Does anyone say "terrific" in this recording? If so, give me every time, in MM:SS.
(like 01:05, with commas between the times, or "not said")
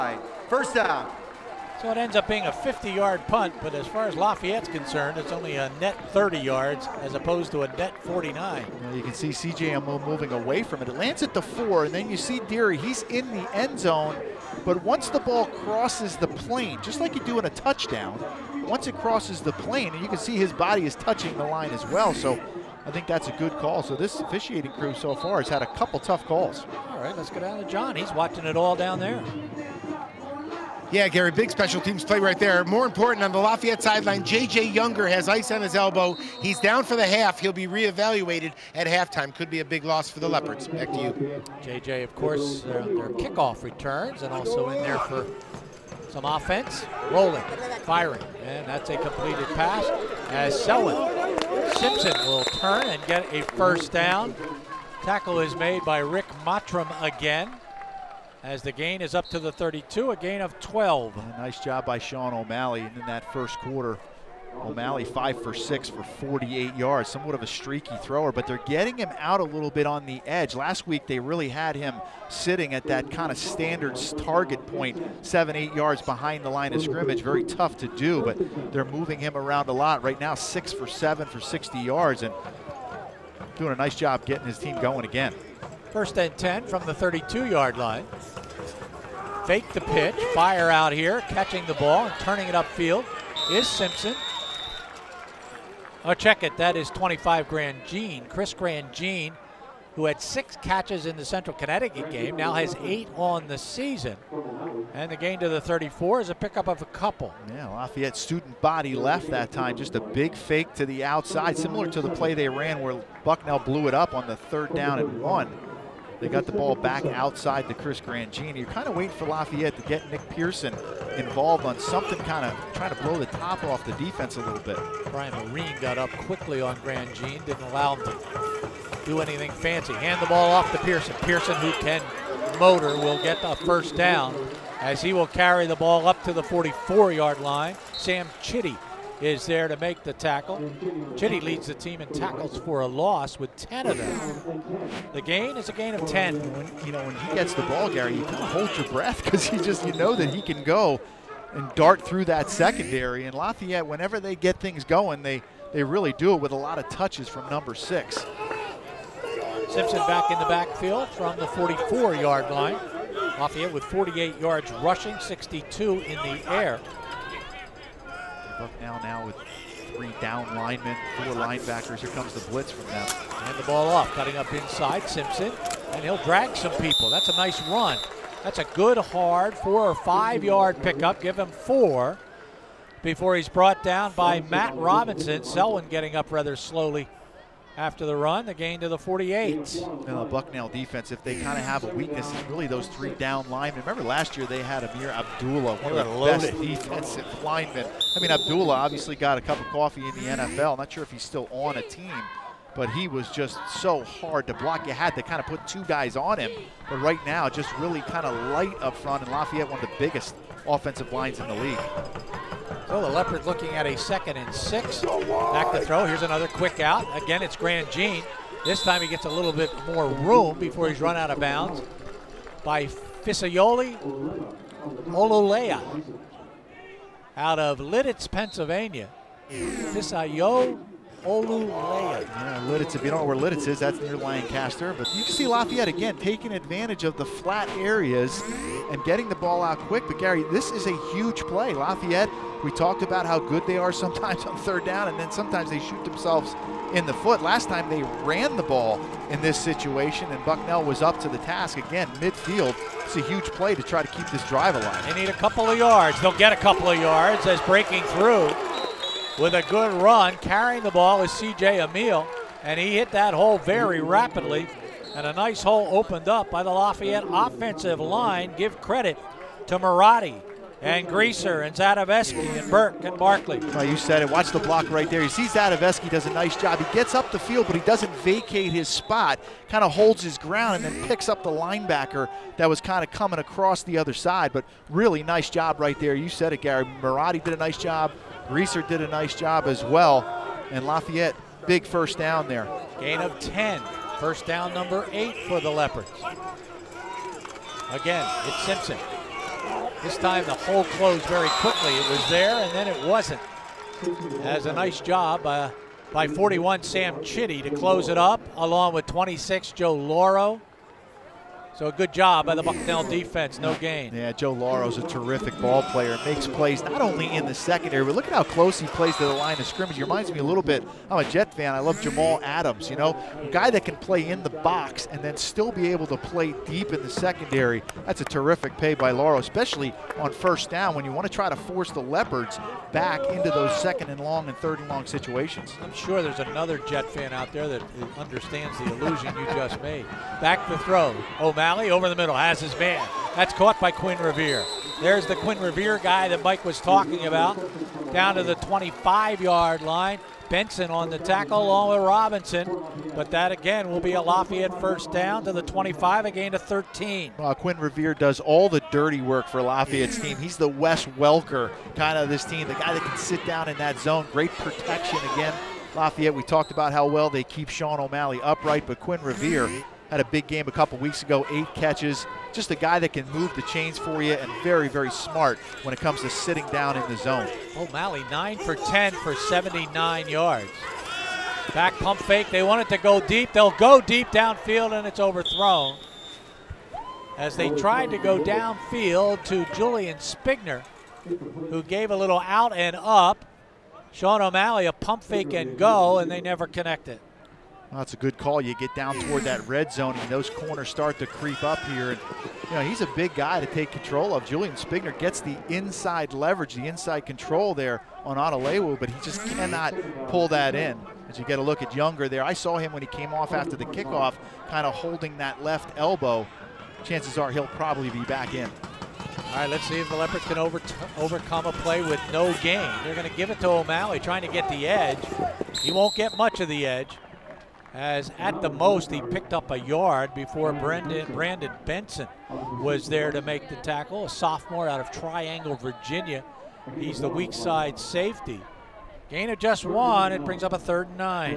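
05:15, 05:28.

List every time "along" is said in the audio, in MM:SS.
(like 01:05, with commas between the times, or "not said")
05:08, 05:51.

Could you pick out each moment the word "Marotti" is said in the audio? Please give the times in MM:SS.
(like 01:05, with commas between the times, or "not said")
04:29, 04:47.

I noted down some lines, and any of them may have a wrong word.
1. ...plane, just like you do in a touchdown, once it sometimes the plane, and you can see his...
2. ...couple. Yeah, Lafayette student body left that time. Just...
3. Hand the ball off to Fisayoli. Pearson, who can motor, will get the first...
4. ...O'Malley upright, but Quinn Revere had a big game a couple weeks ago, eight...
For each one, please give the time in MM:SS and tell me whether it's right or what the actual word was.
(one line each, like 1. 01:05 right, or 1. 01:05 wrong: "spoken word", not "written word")
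1. 00:16 wrong: "crosses", not "sometimes"
2. 01:46 right
3. 02:09 wrong: "Pearson", not "Fisayoli"
4. 06:07 right.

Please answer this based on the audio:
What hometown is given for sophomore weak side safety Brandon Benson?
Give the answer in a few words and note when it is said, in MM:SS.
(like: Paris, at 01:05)
Triangle, Virginia, at 07:15.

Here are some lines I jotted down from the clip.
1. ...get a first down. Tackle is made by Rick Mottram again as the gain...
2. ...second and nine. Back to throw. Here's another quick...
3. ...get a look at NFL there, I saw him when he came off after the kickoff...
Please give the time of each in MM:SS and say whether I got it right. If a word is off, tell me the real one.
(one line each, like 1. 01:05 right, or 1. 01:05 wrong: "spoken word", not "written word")
1. 00:53 right
2. 03:33 wrong: "six", not "nine"
3. 06:51 wrong: "Younger", not "NFL".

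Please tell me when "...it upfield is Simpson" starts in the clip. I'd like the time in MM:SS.
01:32.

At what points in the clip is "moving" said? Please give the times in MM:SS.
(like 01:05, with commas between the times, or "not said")
00:10, 01:18.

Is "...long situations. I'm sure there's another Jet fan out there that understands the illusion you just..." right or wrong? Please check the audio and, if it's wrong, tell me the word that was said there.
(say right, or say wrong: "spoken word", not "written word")
right.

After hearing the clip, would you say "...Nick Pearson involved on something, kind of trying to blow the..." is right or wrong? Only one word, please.
right.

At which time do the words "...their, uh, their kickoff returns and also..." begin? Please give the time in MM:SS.
00:42.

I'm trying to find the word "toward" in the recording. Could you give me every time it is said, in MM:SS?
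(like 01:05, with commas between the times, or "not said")
06:39.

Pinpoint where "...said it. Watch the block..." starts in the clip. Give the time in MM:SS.
04:33.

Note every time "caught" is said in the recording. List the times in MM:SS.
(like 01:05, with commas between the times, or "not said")
05:43.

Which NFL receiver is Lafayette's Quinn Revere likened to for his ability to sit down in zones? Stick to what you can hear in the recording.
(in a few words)
Wes Welker.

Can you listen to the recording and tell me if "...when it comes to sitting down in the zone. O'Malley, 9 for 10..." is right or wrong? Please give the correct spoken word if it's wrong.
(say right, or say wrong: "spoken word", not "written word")
right.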